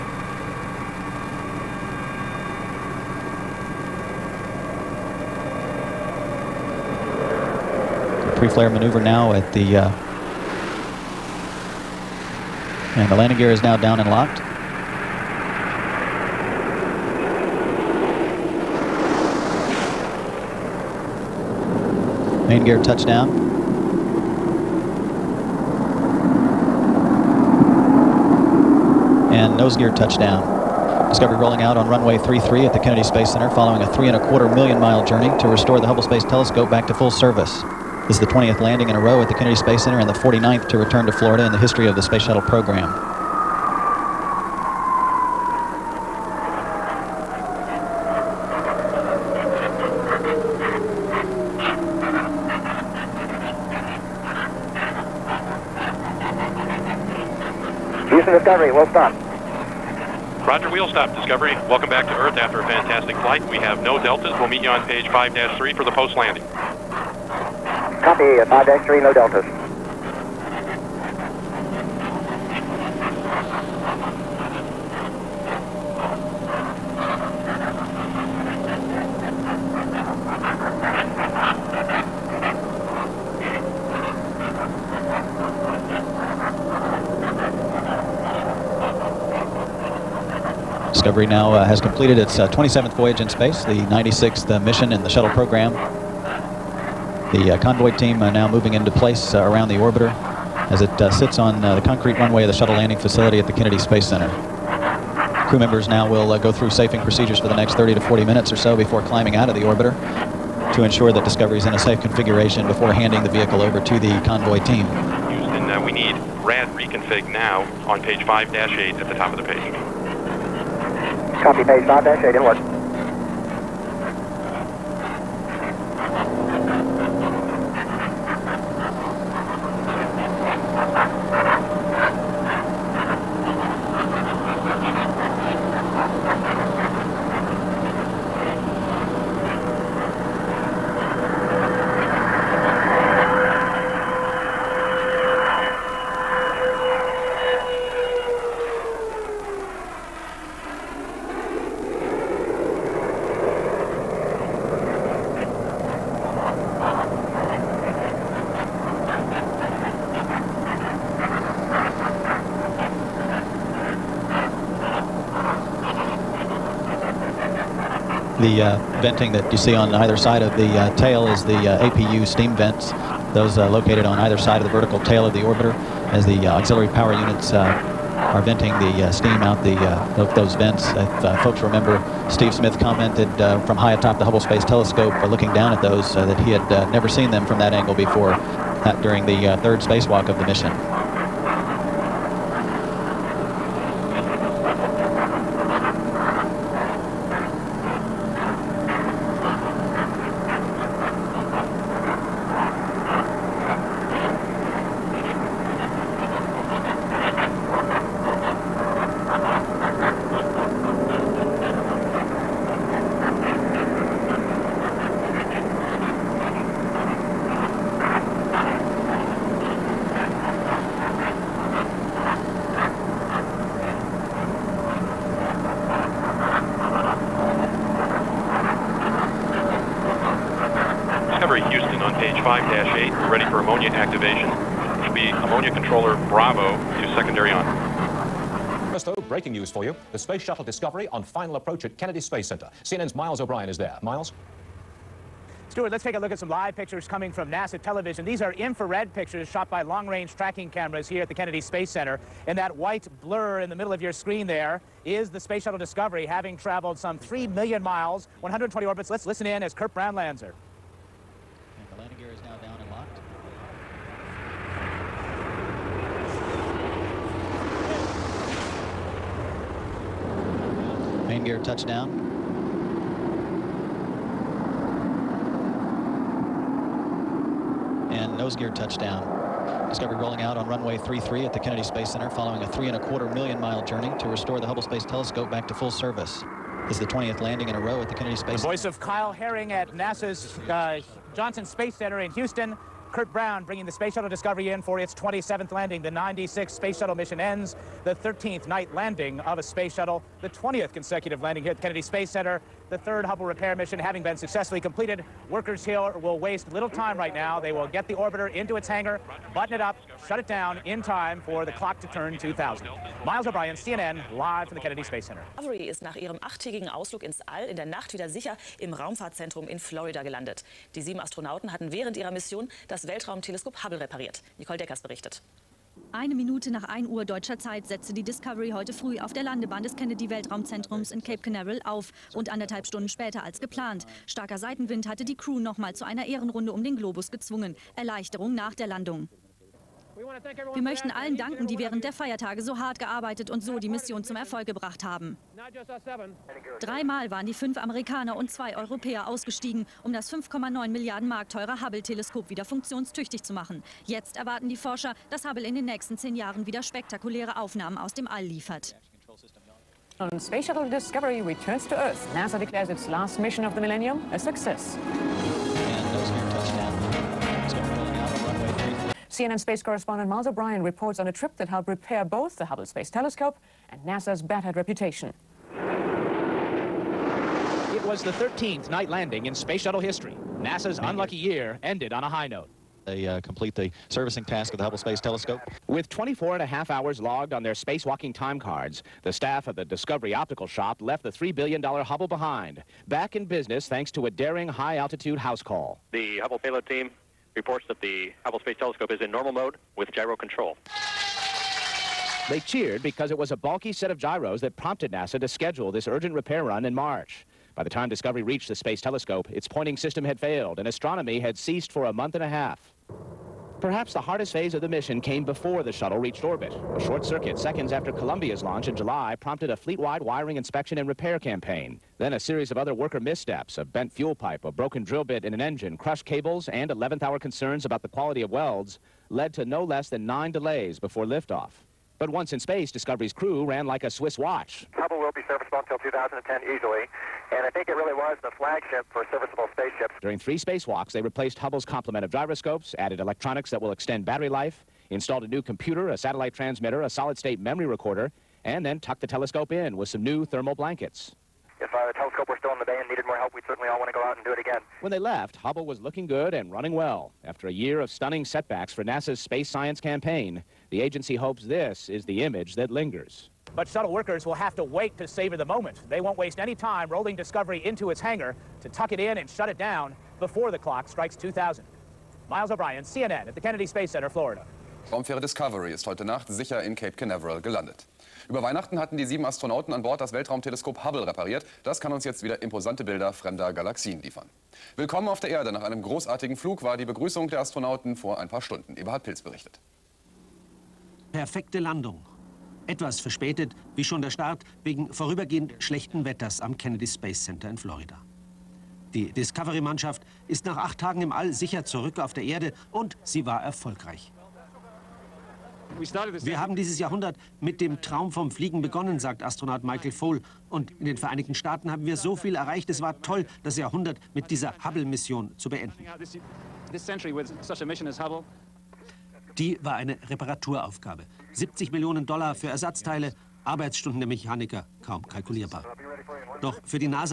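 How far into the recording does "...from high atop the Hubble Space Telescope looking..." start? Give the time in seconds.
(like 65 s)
183 s.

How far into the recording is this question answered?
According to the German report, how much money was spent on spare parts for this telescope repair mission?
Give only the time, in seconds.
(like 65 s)
521 s.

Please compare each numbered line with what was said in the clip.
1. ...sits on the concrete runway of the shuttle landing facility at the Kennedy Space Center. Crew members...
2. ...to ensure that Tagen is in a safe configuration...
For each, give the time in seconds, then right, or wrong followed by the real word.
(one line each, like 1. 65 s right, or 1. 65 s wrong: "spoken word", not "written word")
1. 101 s right
2. 110 s wrong: "Discovery", not "Tagen".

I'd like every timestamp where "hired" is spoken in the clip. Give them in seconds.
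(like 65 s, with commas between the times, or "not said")
not said.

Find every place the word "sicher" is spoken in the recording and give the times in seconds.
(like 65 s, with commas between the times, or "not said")
318 s, 476 s, 501 s.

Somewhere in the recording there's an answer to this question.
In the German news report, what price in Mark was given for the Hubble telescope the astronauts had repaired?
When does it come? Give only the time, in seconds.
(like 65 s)
350 s.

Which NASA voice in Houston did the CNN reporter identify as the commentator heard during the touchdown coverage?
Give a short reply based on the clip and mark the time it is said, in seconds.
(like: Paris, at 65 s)
Kyle Herring, at 288 s.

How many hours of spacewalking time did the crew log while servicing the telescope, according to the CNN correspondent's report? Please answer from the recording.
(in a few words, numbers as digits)
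24 and a half hours.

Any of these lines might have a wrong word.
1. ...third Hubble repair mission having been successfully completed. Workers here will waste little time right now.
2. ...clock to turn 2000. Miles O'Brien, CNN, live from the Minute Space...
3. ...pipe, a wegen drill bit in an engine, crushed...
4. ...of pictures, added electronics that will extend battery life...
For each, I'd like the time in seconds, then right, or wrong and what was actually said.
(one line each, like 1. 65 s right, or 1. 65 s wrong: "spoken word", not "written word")
1. 302 s right
2. 311 s wrong: "Kennedy", not "Minute"
3. 424 s wrong: "broken", not "wegen"
4. 442 s wrong: "gyroscopes", not "pictures".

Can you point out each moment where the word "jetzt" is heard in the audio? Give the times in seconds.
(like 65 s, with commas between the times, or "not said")
354 s, 482 s.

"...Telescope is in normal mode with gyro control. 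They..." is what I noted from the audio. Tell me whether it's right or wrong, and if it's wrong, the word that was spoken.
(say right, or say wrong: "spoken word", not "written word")
right.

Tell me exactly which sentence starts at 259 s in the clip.
Let's listen in as Curt her.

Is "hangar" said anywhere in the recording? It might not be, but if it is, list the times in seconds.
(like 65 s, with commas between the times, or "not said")
308 s, 468 s.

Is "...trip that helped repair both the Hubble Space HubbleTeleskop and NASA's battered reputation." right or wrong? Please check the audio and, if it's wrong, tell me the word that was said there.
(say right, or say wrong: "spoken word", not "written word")
wrong: "Telescope", not "HubbleTeleskop".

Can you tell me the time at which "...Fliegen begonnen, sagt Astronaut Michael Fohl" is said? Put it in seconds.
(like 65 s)
508 s.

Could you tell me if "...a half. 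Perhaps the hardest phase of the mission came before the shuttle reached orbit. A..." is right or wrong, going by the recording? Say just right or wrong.
right.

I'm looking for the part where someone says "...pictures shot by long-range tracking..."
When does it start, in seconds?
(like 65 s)
249 s.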